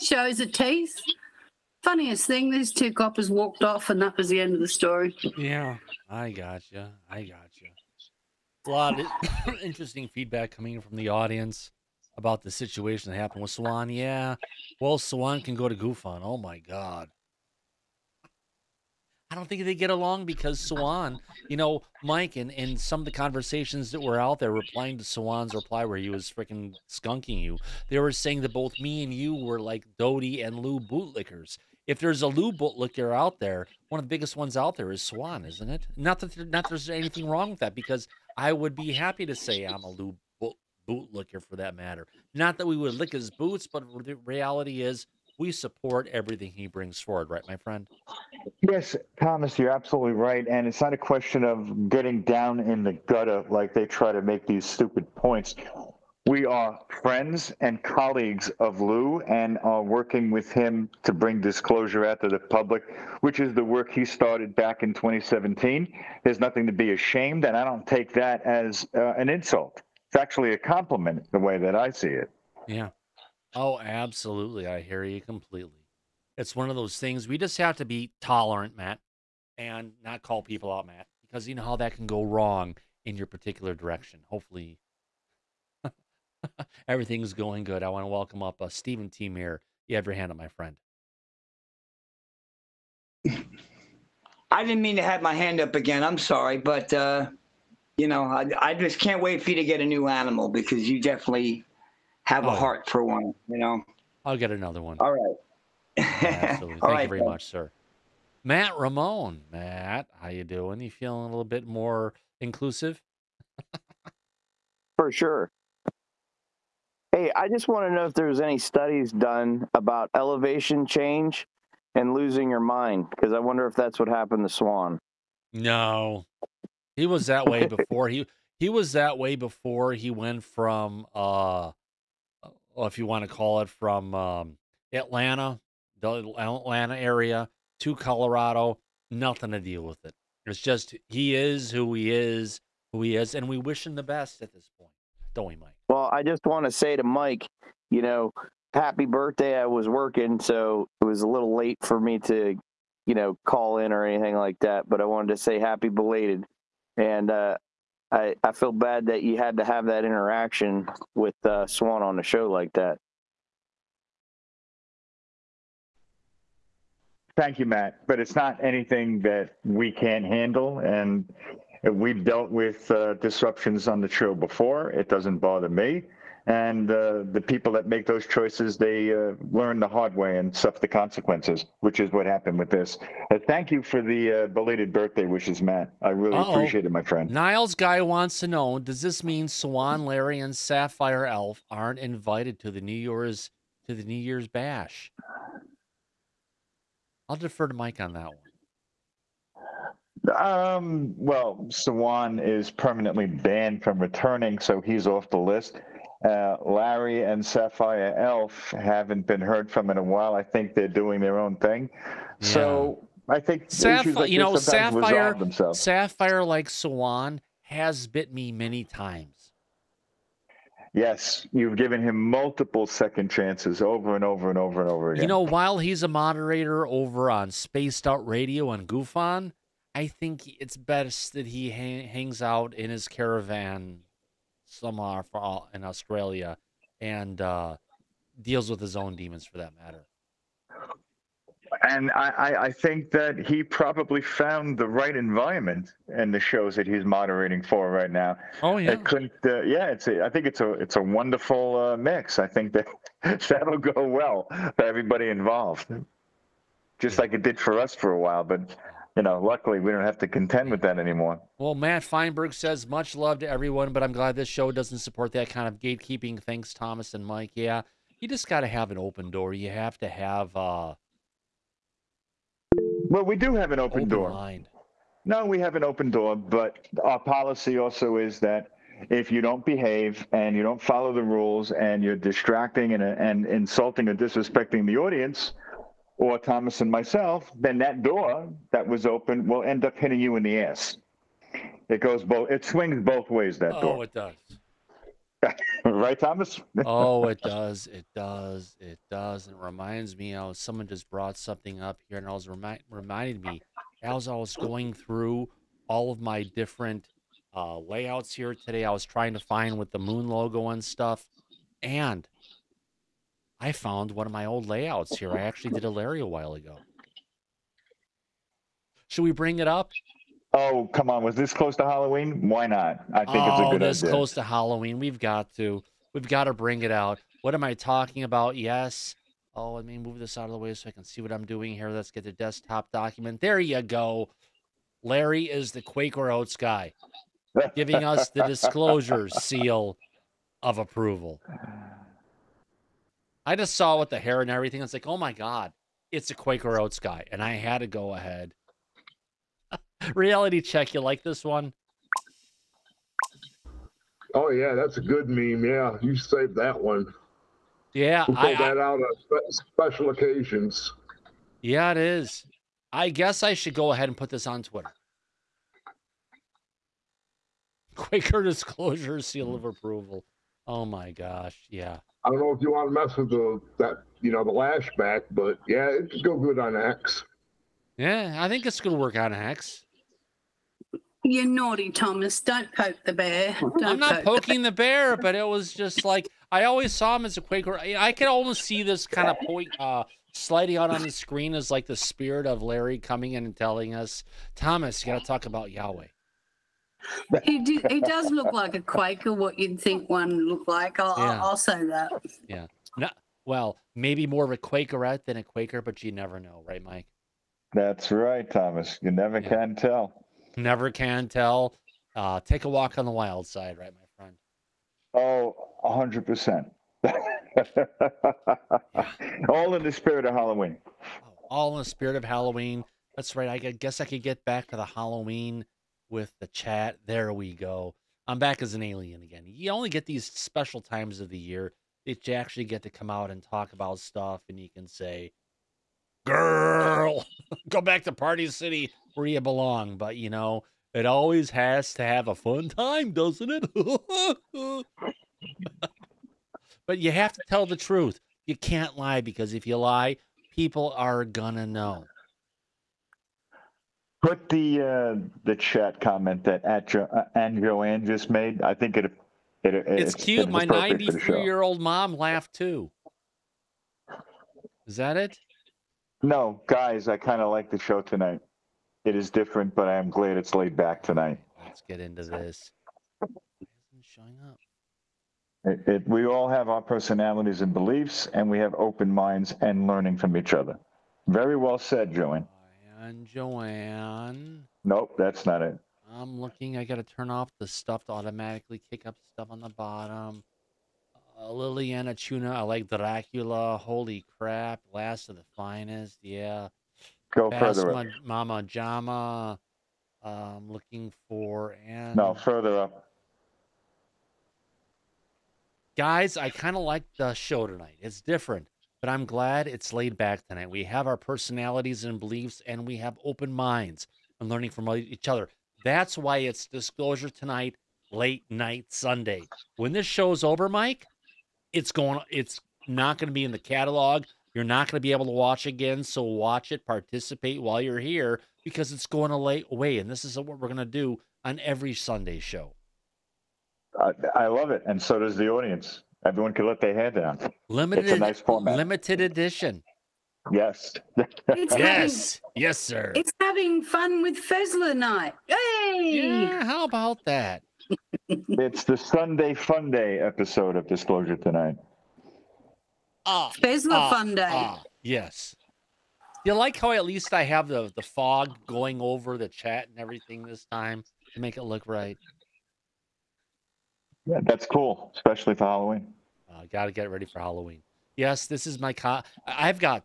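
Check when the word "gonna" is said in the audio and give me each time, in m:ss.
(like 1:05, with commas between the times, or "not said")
6:18, 7:31.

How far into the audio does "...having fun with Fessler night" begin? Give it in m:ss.
9:03.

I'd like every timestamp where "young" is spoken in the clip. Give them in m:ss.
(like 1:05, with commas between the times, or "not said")
not said.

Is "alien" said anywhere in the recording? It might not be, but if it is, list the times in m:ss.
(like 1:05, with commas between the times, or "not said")
7:08.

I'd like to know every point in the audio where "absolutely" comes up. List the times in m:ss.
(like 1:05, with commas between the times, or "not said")
0:49, 1:13, 1:46.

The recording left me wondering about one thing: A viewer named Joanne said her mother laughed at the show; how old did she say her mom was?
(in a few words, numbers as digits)
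93.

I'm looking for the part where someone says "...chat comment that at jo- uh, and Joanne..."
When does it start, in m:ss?
7:35.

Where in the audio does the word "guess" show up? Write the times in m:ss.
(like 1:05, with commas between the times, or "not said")
6:03, 7:03.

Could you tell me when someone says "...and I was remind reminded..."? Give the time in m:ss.
5:02.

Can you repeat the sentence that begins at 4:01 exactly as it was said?
And I, I, think that he probably found the right environment in the shows that he's moderating for right now.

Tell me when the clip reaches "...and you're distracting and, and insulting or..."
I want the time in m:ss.
4:41.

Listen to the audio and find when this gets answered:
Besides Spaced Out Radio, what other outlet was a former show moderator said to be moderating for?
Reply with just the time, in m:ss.
3:48.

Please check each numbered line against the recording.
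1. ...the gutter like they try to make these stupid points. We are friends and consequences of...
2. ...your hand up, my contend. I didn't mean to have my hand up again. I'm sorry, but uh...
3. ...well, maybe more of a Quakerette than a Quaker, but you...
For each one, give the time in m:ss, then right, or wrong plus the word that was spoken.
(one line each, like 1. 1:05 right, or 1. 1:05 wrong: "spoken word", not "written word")
1. 0:52 wrong: "colleagues", not "consequences"
2. 1:30 wrong: "friend", not "contend"
3. 6:43 right.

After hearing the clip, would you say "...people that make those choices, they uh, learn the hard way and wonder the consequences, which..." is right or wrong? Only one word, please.
wrong.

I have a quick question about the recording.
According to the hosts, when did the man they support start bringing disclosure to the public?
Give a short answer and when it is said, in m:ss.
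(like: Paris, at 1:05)
2017, at 1:04.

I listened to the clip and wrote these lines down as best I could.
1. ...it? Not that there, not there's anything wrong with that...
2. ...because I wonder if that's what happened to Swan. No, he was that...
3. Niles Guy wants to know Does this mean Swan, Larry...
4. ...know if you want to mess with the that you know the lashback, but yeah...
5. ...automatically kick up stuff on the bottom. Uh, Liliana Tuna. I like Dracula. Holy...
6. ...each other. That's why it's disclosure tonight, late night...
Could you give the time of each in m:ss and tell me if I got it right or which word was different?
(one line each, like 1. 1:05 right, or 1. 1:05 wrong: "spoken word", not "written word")
1. 0:35 right
2. 2:03 right
3. 3:07 right
4. 6:12 right
5. 8:08 right
6. 8:34 right.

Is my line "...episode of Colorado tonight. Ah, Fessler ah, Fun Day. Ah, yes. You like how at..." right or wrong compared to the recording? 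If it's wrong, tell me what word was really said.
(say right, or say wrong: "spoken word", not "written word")
wrong: "Disclosure", not "Colorado".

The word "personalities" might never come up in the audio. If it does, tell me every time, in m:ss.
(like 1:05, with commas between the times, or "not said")
7:56, 8:31.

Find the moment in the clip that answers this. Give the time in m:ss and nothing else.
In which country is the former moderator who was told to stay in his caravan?
3:55.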